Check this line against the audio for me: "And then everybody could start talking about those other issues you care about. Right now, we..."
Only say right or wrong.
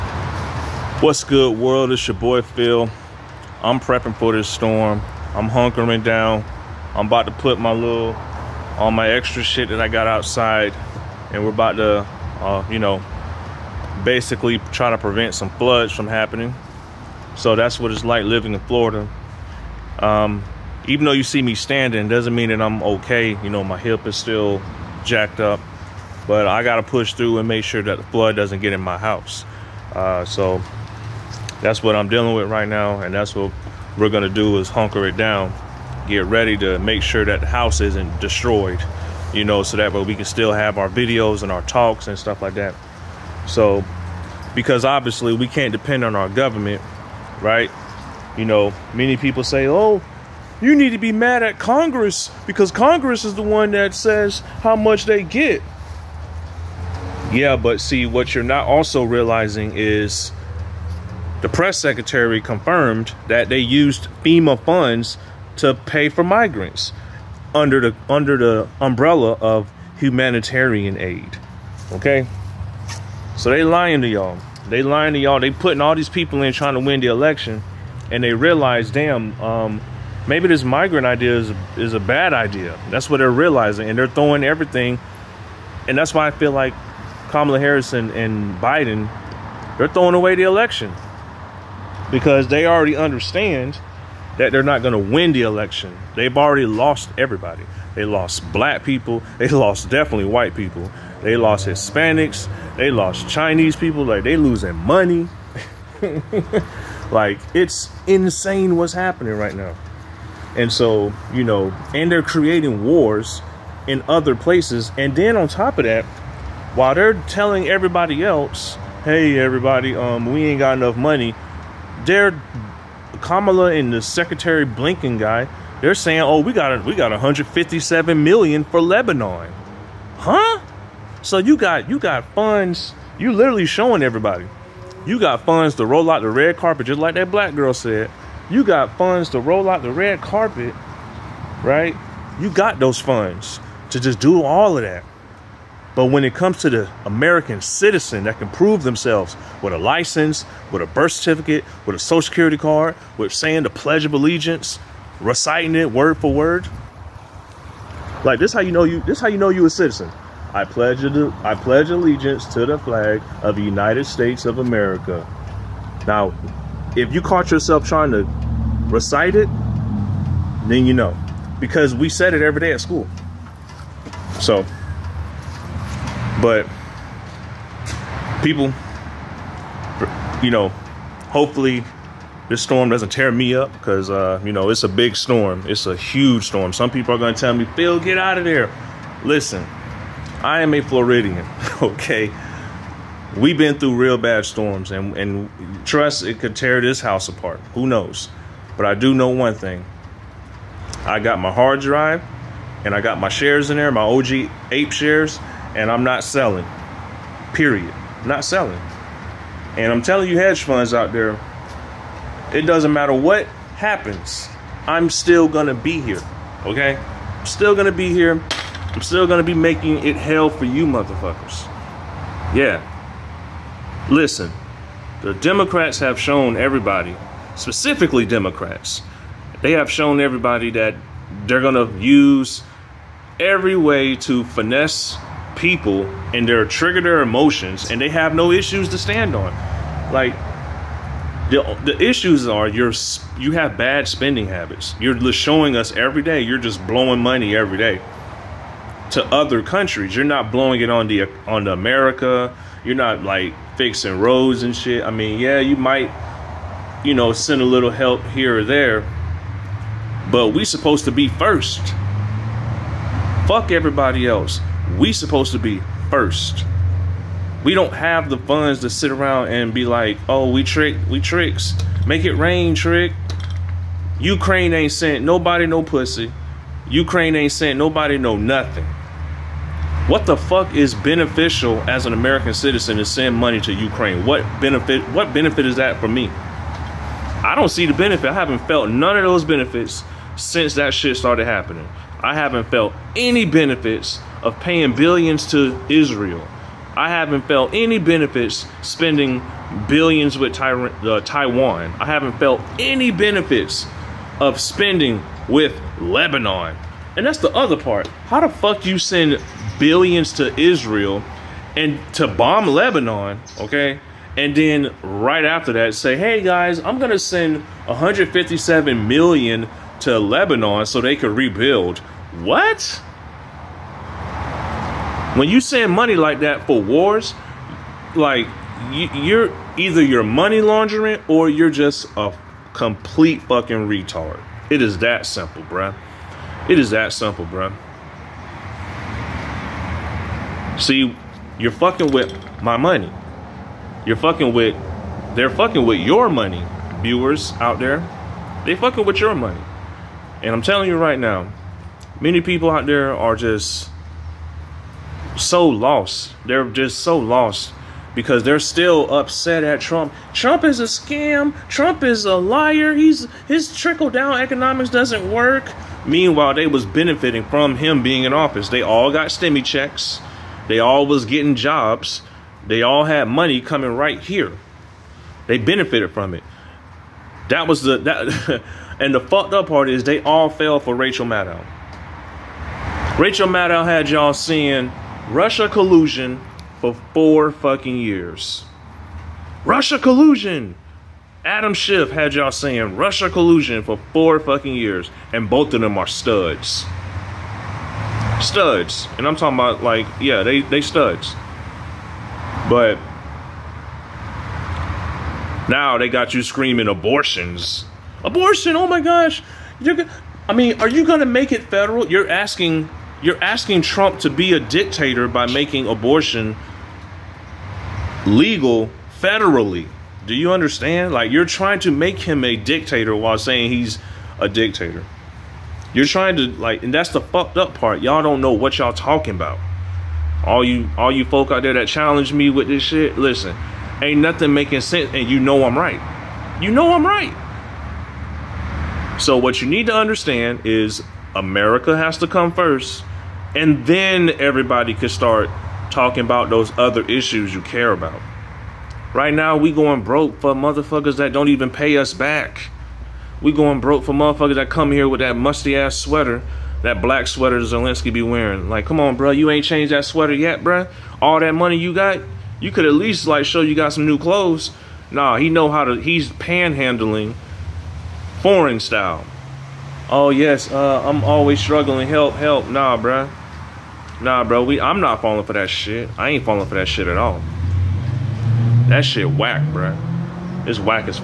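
right.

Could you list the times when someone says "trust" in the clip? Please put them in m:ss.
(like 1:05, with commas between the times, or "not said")
3:15.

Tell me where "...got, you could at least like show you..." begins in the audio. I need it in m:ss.
7:41.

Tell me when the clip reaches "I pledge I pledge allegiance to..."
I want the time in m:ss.
2:40.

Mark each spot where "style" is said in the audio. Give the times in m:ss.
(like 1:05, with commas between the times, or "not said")
7:48.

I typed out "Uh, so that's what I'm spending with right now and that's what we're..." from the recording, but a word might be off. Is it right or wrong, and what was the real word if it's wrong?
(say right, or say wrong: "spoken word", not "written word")
wrong: "dealing", not "spending".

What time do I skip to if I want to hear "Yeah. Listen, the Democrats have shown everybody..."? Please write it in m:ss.
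3:42.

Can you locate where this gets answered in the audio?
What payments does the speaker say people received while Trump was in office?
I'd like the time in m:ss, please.
6:09.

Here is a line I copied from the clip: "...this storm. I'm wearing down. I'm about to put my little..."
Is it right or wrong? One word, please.
wrong.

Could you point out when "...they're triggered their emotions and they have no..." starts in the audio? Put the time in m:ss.
3:56.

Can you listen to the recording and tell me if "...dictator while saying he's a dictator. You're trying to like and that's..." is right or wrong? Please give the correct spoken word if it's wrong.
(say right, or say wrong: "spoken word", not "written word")
right.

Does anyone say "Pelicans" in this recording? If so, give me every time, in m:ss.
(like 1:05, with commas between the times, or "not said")
not said.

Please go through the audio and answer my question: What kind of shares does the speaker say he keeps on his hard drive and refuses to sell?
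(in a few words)
OG ape shares.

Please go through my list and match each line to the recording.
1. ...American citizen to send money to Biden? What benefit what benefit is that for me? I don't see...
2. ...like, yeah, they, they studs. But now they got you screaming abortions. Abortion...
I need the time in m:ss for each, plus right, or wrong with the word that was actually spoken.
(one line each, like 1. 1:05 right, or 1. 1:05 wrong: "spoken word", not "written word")
1. 4:42 wrong: "Ukraine", not "Biden"
2. 6:39 right.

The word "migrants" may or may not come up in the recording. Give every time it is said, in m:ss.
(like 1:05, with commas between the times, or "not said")
1:06, 1:20.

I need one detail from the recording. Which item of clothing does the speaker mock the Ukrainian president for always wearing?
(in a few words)
black sweater.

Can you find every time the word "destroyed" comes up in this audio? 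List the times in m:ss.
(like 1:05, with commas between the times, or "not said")
0:38.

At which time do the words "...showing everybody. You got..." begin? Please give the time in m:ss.
2:13.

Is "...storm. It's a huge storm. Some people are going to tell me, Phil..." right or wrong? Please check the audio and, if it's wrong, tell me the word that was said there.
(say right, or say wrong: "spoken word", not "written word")
right.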